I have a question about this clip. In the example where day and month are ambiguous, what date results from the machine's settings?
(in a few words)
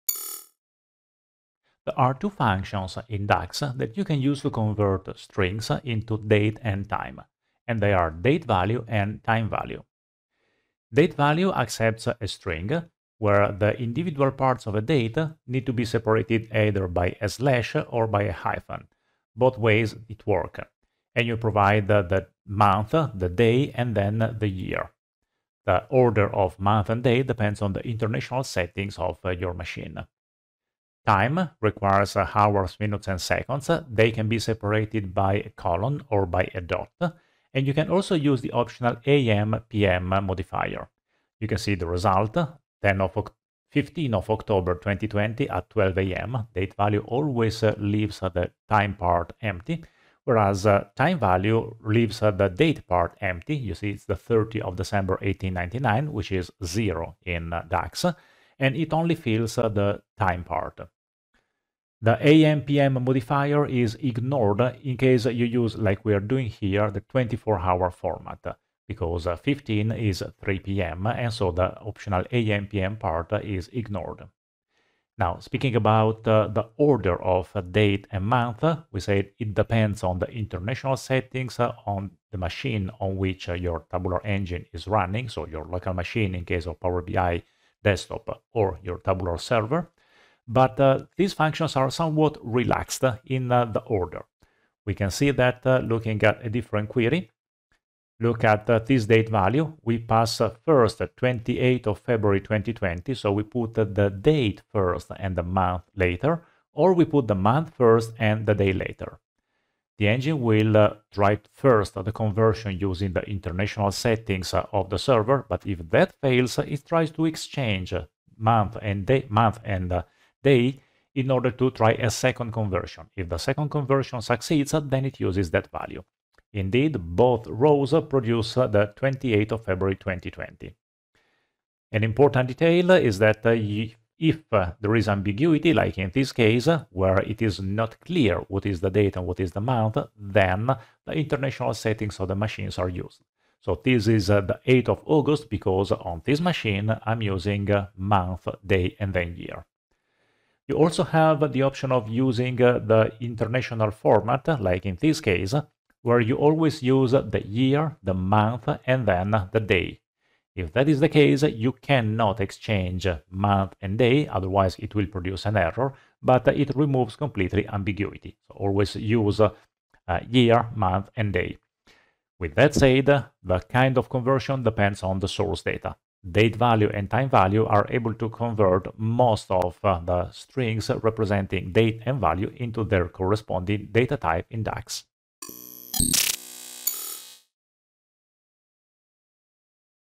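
8 August.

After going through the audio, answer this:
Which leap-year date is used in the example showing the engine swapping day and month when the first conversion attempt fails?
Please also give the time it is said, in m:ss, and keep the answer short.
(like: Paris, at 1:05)
28 February 2020, at 1:40.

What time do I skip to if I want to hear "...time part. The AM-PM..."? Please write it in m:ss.
1:00.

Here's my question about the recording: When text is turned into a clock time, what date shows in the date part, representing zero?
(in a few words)
30 December 1899.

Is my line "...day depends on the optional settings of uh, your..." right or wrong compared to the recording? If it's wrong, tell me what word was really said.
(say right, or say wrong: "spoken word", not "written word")
wrong: "international", not "optional".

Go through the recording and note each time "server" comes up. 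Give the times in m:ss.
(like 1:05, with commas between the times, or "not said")
1:29, 1:54.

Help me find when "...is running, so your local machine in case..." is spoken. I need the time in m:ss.
1:24.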